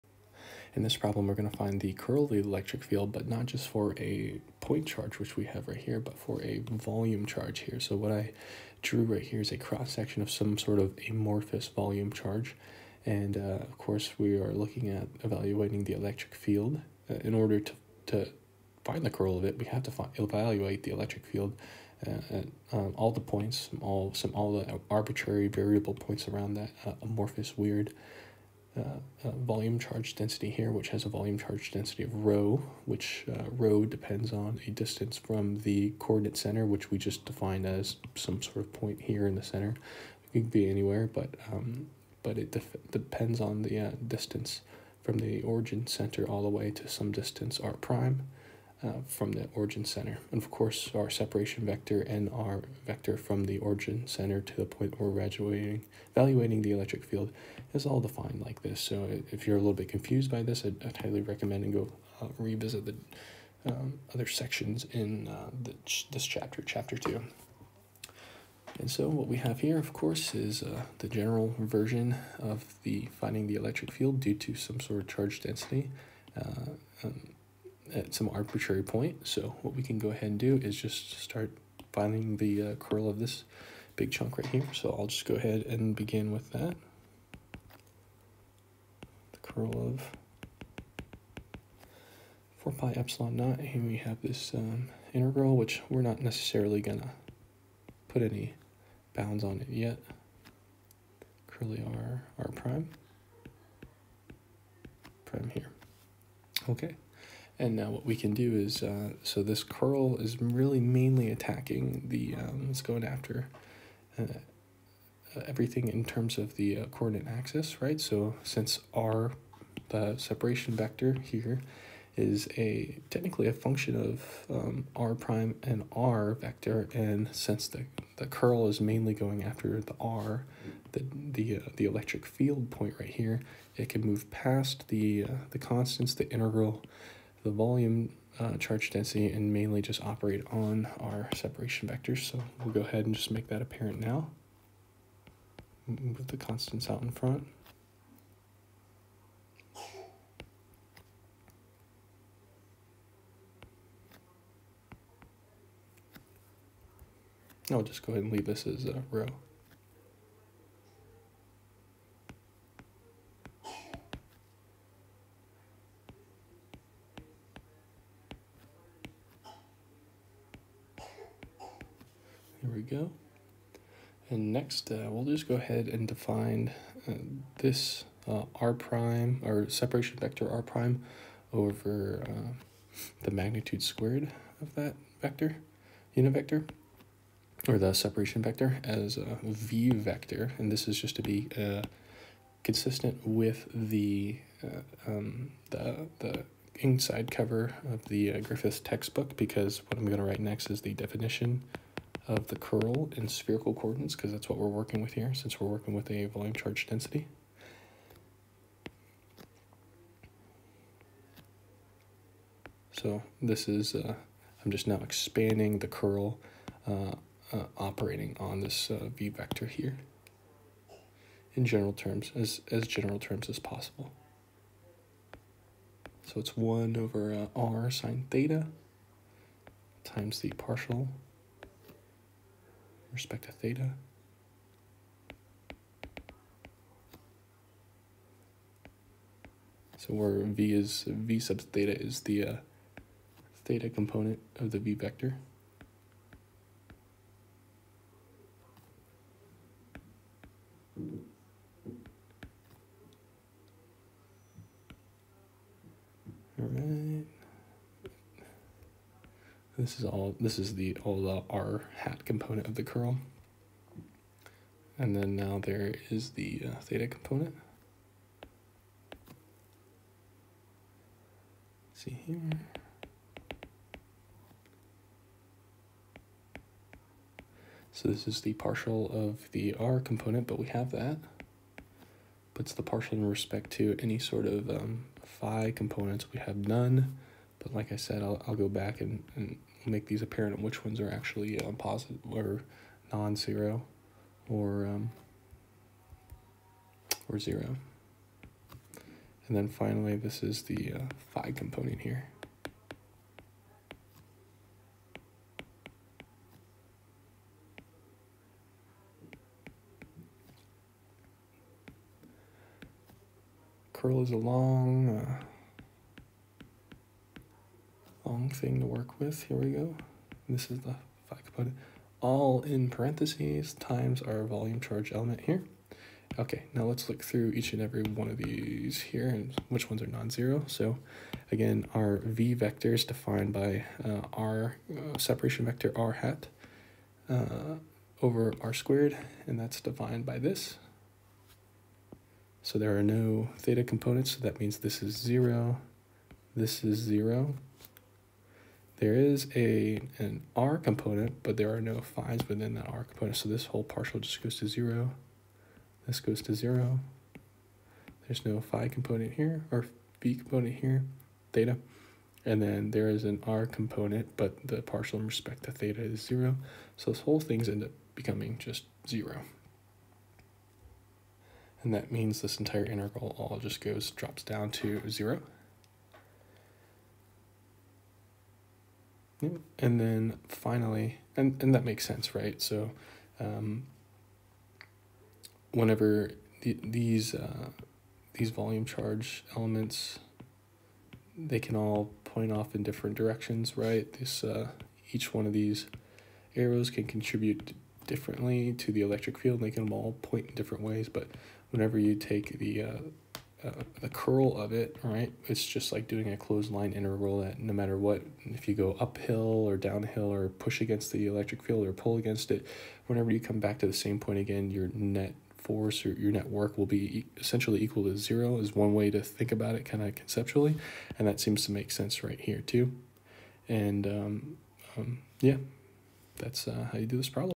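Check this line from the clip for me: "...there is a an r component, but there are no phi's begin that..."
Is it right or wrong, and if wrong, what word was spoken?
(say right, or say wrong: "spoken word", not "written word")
wrong: "within", not "begin".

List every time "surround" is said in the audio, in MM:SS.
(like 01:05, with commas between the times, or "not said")
not said.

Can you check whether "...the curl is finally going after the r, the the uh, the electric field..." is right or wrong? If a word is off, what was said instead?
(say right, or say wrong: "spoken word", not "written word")
wrong: "mainly", not "finally".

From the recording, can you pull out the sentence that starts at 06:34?
This, uh, each one of these arrows can contribute differently to the electric field.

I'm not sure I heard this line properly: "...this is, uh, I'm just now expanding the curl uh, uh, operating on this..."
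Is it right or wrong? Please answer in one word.
right.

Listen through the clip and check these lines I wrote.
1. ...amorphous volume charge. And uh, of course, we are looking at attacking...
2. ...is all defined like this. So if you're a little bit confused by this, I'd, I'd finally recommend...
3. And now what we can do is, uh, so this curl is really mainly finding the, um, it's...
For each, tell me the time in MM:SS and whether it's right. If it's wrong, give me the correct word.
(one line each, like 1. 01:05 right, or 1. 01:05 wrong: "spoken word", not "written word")
1. 00:11 wrong: "evaluating", not "attacking"
2. 00:57 wrong: "highly", not "finally"
3. 01:47 wrong: "attacking", not "finding".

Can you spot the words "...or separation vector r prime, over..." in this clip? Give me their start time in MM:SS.
02:59.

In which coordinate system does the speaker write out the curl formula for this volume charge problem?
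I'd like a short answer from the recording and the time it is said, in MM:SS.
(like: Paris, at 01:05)
Spherical coordinates, at 03:23.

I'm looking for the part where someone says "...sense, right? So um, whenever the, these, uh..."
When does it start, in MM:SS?
06:22.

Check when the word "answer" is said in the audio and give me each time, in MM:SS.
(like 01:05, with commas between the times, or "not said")
not said.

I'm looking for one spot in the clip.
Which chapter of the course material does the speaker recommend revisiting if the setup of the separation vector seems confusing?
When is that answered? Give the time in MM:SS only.
01:06.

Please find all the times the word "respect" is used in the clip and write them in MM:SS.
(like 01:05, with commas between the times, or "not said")
03:53, 04:43, 06:05.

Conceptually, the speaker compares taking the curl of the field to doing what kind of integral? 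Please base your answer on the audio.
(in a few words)
Closed line integral.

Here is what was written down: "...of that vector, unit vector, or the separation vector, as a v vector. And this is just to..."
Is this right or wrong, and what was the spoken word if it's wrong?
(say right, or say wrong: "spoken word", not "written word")
right.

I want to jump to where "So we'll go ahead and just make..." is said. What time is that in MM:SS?
02:22.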